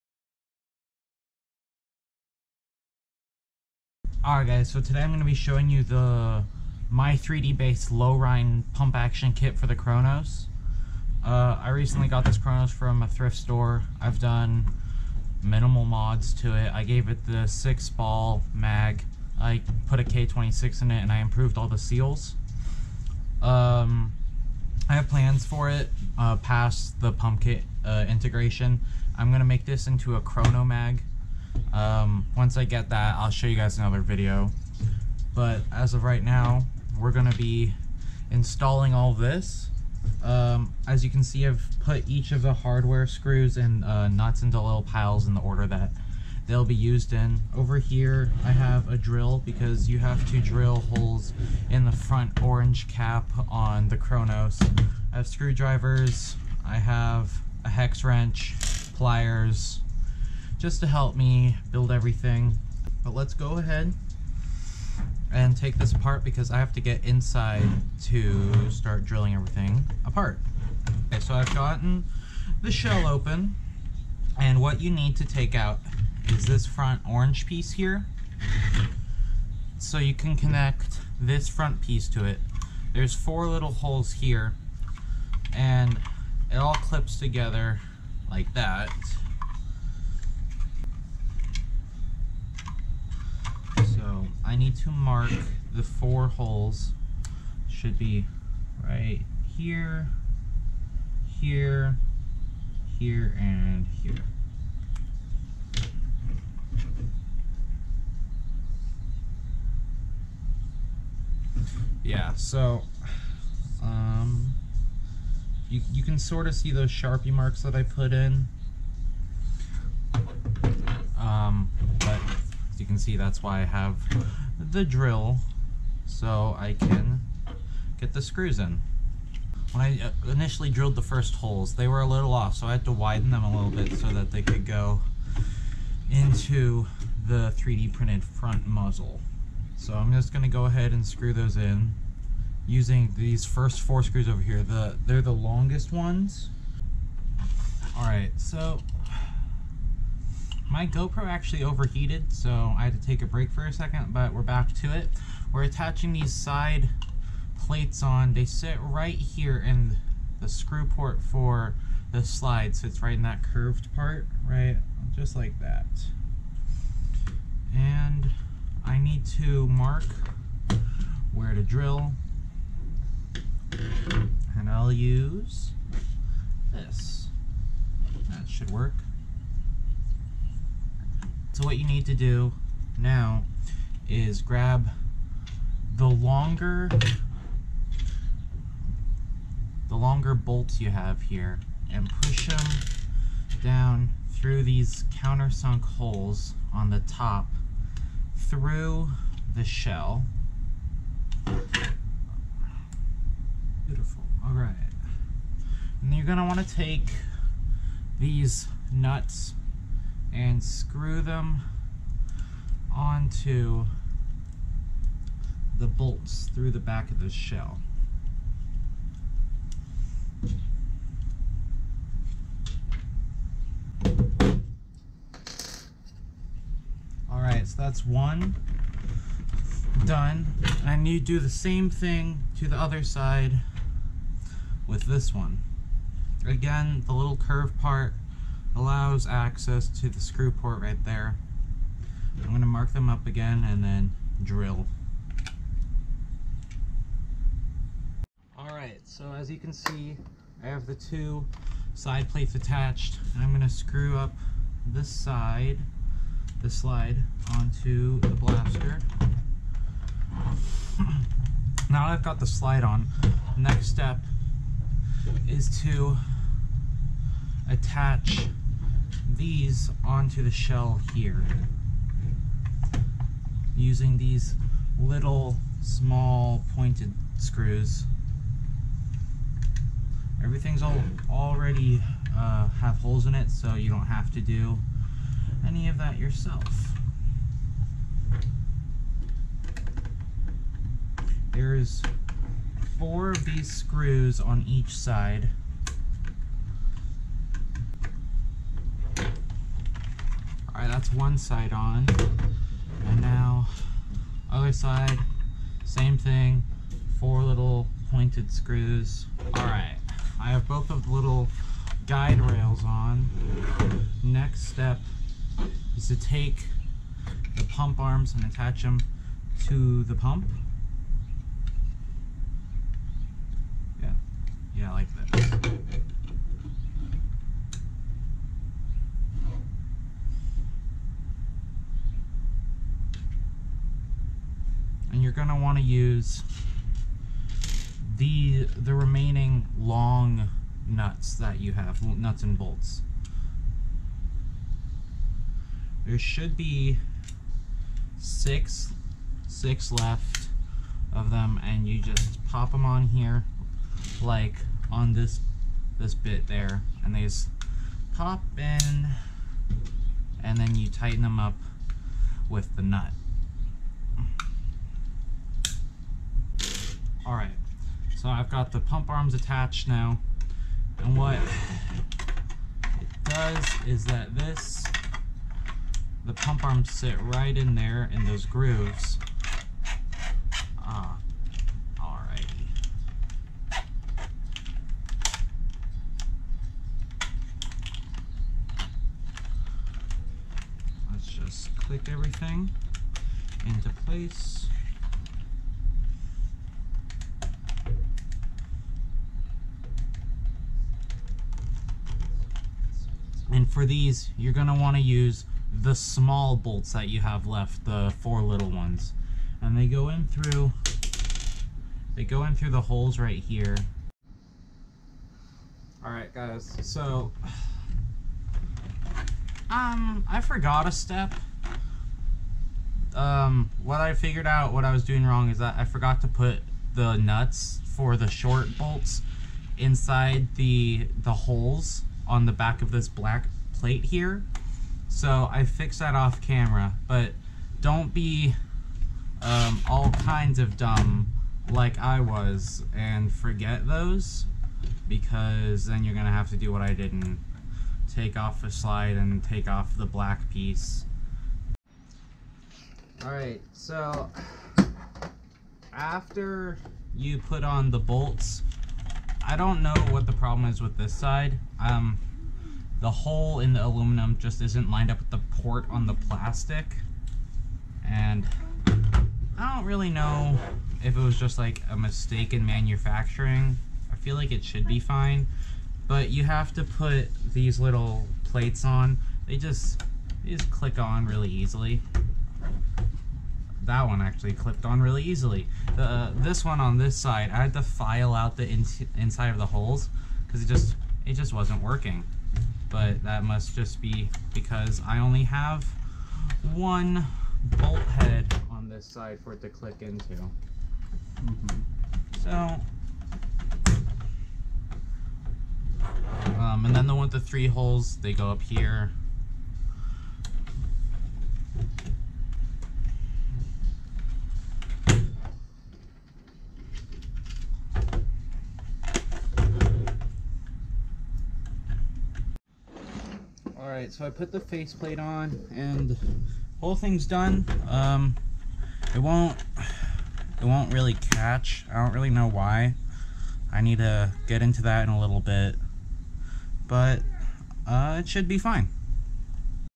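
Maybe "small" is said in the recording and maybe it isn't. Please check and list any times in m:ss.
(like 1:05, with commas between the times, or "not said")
4:35, 6:45.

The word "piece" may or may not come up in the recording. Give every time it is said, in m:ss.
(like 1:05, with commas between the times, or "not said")
1:17, 1:21, 7:30.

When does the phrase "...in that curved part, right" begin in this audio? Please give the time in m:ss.
2:43.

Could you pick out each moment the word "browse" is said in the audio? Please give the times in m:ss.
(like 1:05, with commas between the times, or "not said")
not said.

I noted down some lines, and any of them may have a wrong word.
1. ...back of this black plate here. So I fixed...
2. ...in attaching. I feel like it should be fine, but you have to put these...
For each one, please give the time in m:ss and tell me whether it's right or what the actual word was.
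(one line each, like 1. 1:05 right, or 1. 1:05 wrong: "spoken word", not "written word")
1. 7:12 right
2. 7:52 wrong: "manufacturing", not "attaching".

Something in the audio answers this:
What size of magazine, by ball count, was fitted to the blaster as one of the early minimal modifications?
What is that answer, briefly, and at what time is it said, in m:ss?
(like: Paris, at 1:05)
6 ball mag, at 0:17.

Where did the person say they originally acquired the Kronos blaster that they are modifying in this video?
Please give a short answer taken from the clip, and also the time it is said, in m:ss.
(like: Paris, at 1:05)
a thrift store, at 0:13.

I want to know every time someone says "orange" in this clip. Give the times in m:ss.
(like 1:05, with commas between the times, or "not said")
0:52, 1:17.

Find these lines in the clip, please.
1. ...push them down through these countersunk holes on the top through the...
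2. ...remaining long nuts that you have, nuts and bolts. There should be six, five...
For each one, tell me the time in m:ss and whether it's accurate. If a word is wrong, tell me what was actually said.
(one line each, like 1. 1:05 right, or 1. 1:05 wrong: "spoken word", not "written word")
1. 3:12 right
2. 5:38 wrong: "six", not "five".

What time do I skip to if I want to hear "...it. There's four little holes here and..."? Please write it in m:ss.
1:22.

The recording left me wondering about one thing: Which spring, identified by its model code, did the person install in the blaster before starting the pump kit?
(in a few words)
K26.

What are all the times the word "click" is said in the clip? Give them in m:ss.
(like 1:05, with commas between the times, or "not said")
6:31, 8:00, 8:19.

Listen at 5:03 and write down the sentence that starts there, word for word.
And now, other side, same thing, four little pointed screws.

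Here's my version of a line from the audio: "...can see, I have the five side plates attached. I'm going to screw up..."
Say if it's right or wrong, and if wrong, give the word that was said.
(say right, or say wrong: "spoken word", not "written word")
wrong: "two", not "five".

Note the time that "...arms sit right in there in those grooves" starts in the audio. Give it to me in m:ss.
6:16.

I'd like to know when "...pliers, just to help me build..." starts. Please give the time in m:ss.
0:58.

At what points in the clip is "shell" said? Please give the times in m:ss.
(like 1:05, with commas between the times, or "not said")
1:12, 3:19, 3:37, 4:30.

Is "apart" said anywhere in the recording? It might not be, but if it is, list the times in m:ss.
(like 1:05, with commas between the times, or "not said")
1:05, 1:10.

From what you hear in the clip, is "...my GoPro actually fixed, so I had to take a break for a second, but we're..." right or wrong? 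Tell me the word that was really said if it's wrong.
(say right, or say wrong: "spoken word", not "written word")
wrong: "overheated", not "fixed".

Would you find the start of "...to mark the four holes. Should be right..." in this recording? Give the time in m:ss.
1:34.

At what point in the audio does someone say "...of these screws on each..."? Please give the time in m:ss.
4:53.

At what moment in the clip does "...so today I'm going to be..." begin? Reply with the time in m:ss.
0:04.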